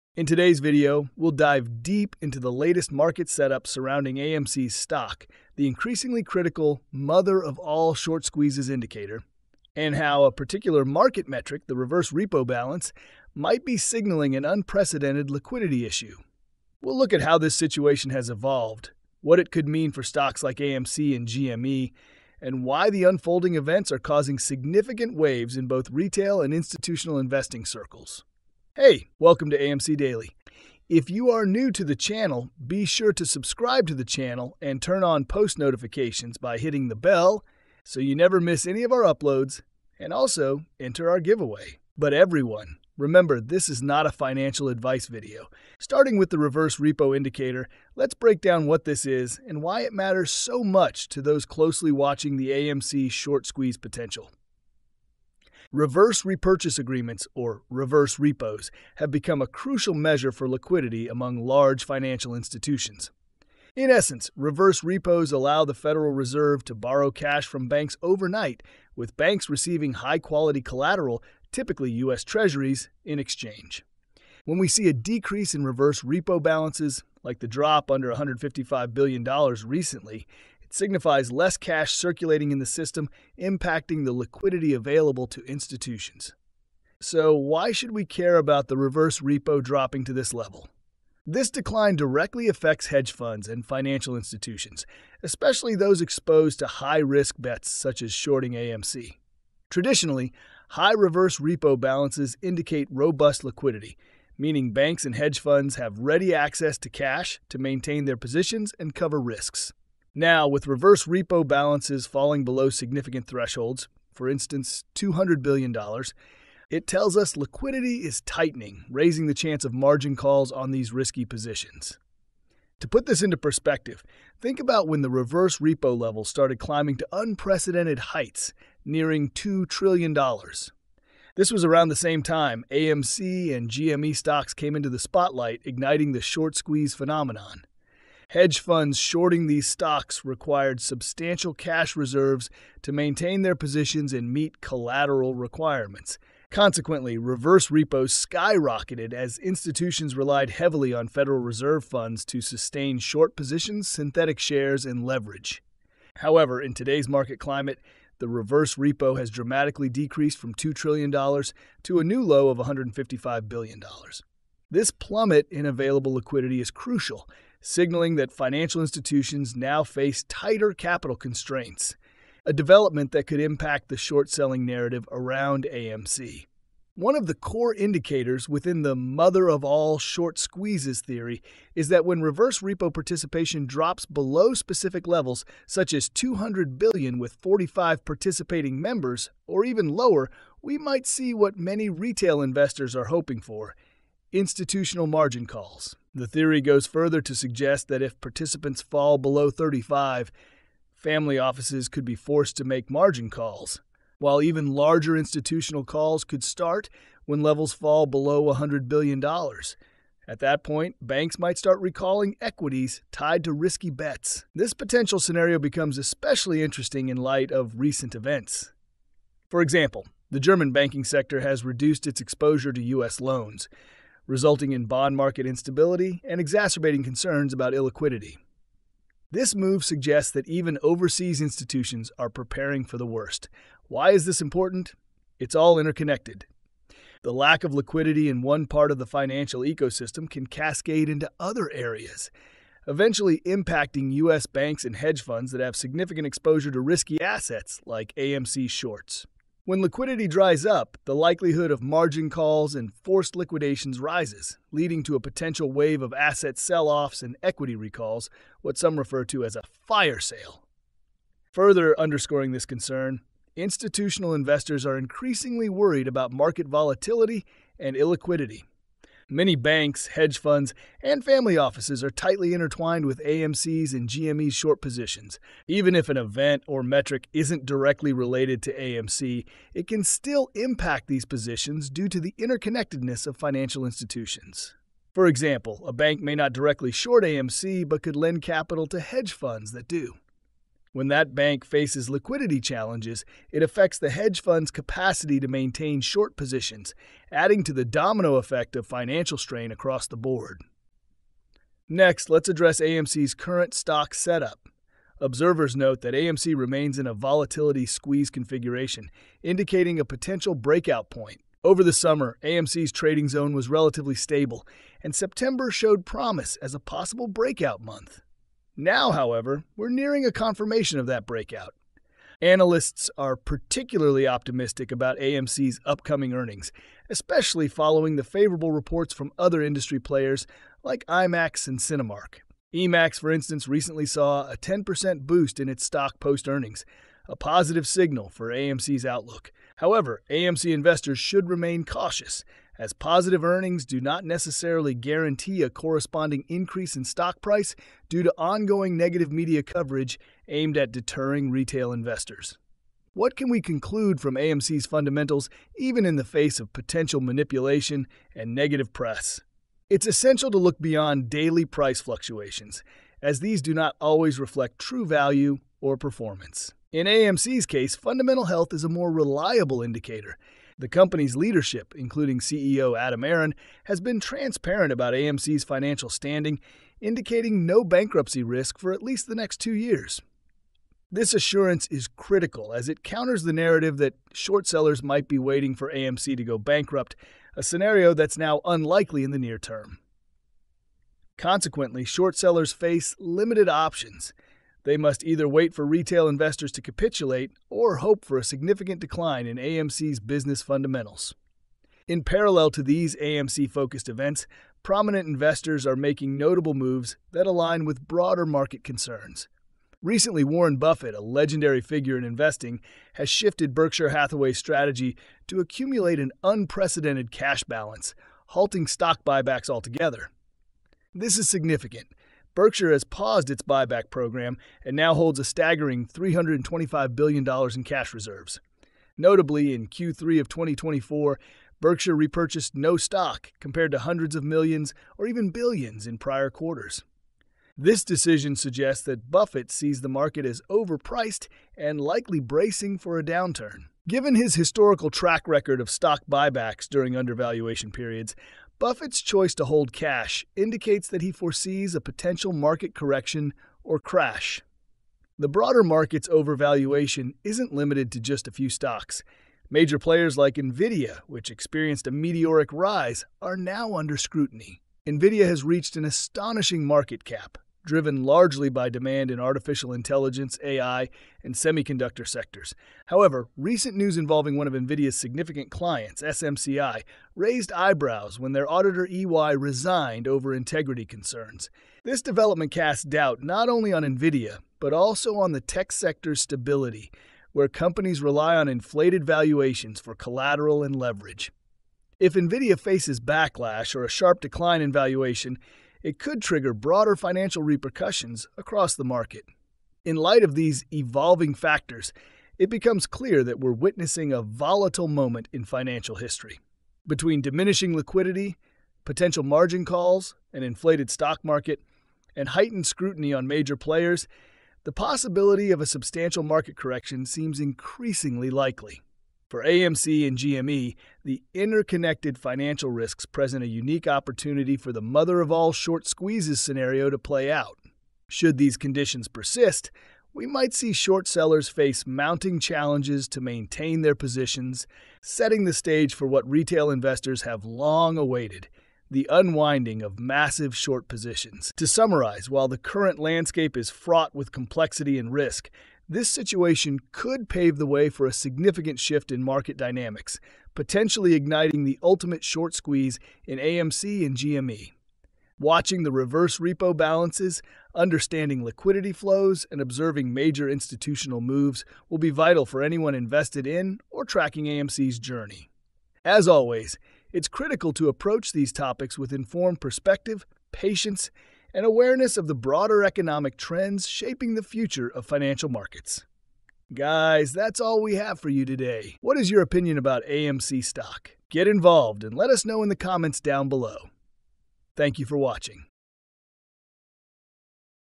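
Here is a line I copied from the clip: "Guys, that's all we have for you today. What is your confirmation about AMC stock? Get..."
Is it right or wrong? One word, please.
wrong.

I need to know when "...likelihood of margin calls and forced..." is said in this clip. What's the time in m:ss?
4:11.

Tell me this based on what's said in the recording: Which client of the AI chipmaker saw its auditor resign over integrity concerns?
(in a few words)
SMCI.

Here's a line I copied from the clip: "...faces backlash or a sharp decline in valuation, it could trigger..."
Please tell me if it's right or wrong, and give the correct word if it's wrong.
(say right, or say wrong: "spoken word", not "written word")
right.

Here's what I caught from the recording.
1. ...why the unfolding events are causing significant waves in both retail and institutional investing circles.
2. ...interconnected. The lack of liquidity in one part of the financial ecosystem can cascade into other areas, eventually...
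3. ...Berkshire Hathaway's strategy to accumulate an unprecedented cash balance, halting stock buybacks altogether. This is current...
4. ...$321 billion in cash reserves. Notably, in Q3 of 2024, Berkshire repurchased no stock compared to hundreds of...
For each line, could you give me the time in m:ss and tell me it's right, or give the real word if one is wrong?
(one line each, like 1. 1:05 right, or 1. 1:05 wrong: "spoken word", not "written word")
1. 0:22 right
2. 3:55 right
3. 6:53 wrong: "significant", not "current"
4. 7:06 wrong: "325", not "321".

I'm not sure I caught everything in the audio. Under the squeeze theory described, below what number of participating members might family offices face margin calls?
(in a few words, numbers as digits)
35.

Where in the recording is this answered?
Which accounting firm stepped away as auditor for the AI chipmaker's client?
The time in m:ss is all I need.
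7:59.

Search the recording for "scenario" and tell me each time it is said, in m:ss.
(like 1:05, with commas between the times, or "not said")
3:35, 6:27, 8:46.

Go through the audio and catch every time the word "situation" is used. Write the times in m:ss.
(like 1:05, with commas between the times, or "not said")
0:17, 9:06.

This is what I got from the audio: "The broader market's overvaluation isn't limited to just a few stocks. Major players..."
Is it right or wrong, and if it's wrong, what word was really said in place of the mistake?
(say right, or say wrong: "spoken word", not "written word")
right.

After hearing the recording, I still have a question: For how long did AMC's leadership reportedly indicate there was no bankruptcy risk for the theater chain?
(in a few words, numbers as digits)
2 years.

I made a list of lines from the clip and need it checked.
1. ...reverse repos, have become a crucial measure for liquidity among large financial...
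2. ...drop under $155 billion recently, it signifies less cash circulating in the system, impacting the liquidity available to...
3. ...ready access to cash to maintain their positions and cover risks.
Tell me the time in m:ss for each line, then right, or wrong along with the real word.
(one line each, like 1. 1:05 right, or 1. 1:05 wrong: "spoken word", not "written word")
1. 0:57 right
2. 1:17 right
3. 1:45 right.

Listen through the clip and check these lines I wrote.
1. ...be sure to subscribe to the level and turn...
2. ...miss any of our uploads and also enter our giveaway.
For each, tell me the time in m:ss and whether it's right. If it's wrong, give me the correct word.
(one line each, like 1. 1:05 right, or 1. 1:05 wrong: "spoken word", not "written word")
1. 0:32 wrong: "channel", not "level"
2. 0:38 right.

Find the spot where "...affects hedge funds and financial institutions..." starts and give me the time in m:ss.
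1:32.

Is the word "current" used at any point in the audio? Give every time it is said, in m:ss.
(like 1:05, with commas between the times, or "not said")
5:03, 9:02.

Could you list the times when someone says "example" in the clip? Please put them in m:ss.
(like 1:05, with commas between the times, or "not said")
3:39, 4:45.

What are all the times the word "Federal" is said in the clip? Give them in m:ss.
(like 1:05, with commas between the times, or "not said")
1:05, 2:31.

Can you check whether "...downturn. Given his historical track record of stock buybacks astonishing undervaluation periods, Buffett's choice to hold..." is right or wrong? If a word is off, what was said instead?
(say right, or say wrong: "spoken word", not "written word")
wrong: "during", not "astonishing".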